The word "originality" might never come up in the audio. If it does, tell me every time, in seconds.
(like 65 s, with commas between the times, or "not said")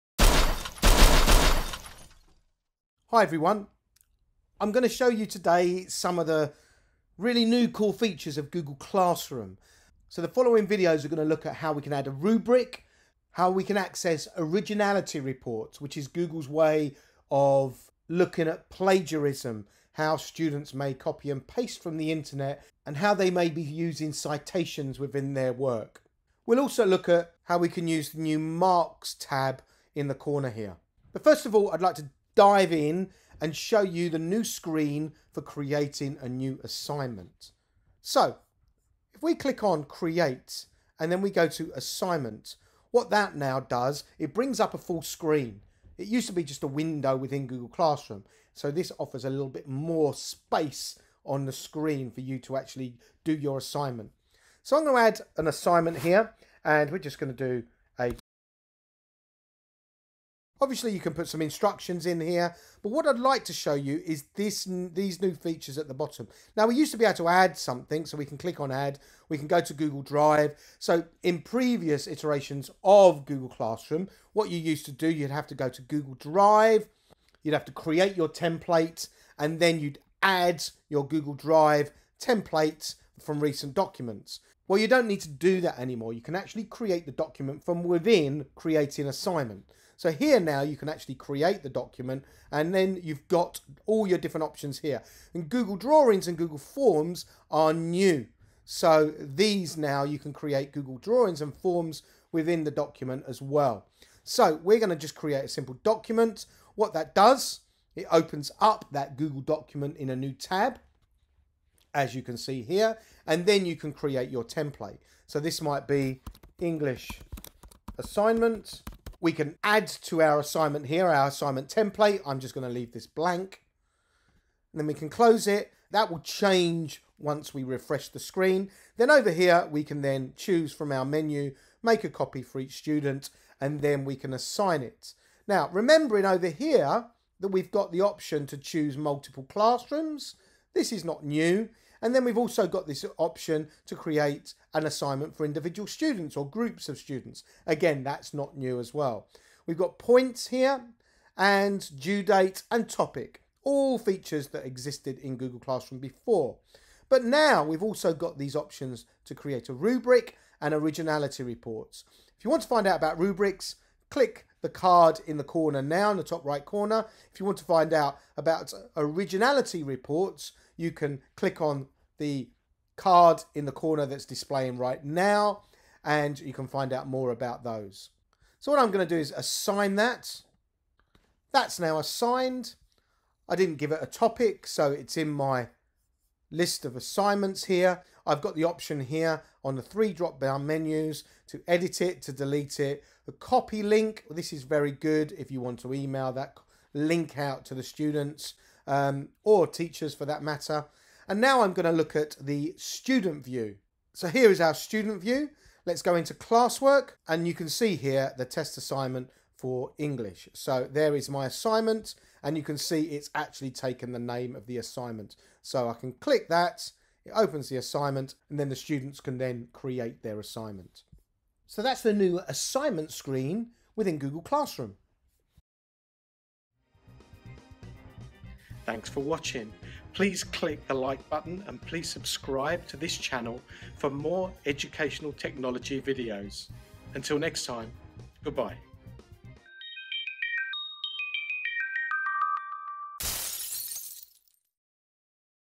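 14 s, 160 s, 168 s.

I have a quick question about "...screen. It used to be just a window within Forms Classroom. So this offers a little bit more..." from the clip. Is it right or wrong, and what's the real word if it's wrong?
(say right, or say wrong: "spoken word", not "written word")
wrong: "Google", not "Forms".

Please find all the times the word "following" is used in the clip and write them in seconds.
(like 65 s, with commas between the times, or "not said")
10 s.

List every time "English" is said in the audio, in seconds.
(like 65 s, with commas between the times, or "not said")
116 s, 209 s.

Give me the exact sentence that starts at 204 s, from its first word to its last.
So here is our student view.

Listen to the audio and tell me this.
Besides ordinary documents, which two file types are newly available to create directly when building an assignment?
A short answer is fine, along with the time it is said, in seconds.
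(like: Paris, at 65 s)
Google Drawings and Google Forms, at 95 s.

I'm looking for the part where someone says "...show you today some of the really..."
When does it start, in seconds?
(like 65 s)
4 s.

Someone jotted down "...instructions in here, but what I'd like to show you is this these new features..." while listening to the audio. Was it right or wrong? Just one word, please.
right.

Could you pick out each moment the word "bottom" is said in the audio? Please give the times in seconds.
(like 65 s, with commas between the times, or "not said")
65 s.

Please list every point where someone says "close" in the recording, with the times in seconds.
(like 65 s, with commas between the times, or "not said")
125 s.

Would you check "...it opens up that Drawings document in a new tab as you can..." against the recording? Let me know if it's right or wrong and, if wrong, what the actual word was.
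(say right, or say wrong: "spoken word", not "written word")
wrong: "Google", not "Drawings".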